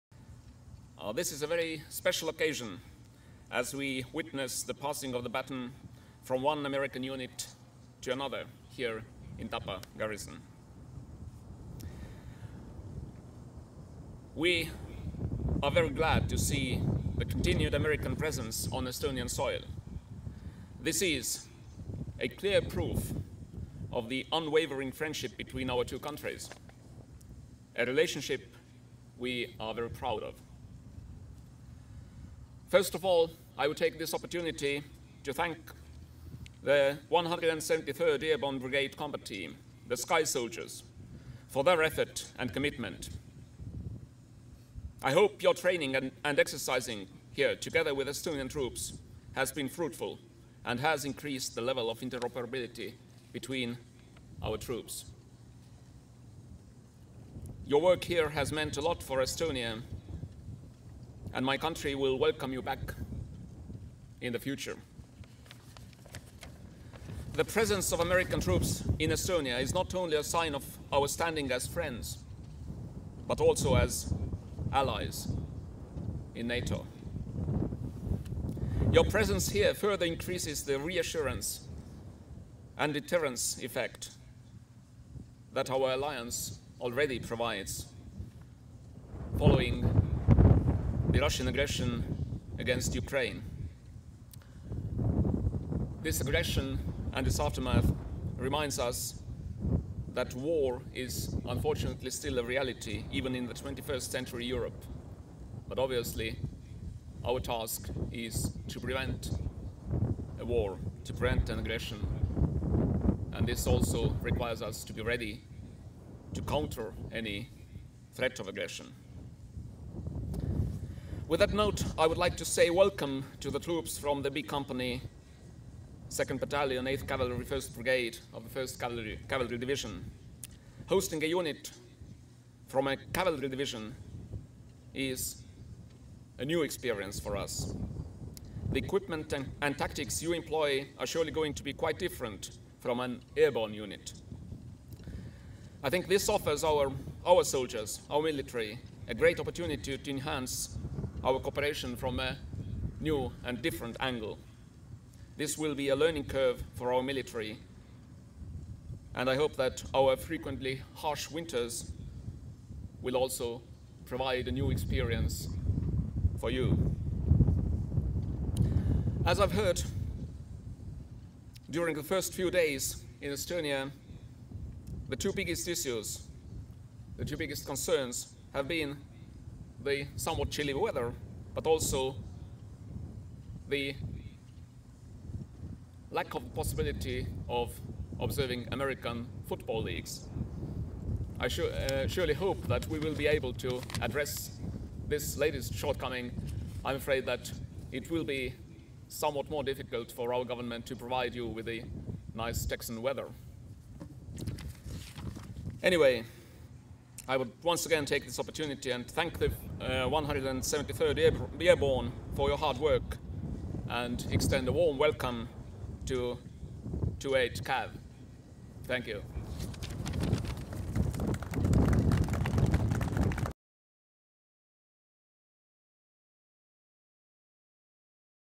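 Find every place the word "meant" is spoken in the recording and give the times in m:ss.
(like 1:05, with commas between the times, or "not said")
0:58.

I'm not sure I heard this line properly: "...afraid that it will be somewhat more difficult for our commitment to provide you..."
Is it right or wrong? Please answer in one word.
wrong.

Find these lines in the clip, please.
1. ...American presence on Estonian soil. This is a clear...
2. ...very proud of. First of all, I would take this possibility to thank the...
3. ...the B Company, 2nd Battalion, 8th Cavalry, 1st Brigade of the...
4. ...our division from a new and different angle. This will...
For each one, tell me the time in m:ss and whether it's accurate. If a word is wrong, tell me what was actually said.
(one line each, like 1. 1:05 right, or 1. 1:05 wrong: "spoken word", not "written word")
1. 0:17 right
2. 0:29 wrong: "opportunity", not "possibility"
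3. 2:04 right
4. 2:31 wrong: "cooperation", not "division".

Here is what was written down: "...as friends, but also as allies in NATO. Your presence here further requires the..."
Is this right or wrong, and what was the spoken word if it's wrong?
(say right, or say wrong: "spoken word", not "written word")
wrong: "increases", not "requires".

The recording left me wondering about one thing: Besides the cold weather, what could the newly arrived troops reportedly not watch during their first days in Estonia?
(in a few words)
American football leagues.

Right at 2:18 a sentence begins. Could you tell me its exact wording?
The equipment and, and, tactics you employ are surely going to be quite different from an airborne unit.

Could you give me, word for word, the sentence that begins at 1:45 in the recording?
But obviously, our task is to prevent a war, to prevent an aggression.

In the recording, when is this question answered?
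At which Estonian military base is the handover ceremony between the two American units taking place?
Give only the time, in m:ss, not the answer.
0:09.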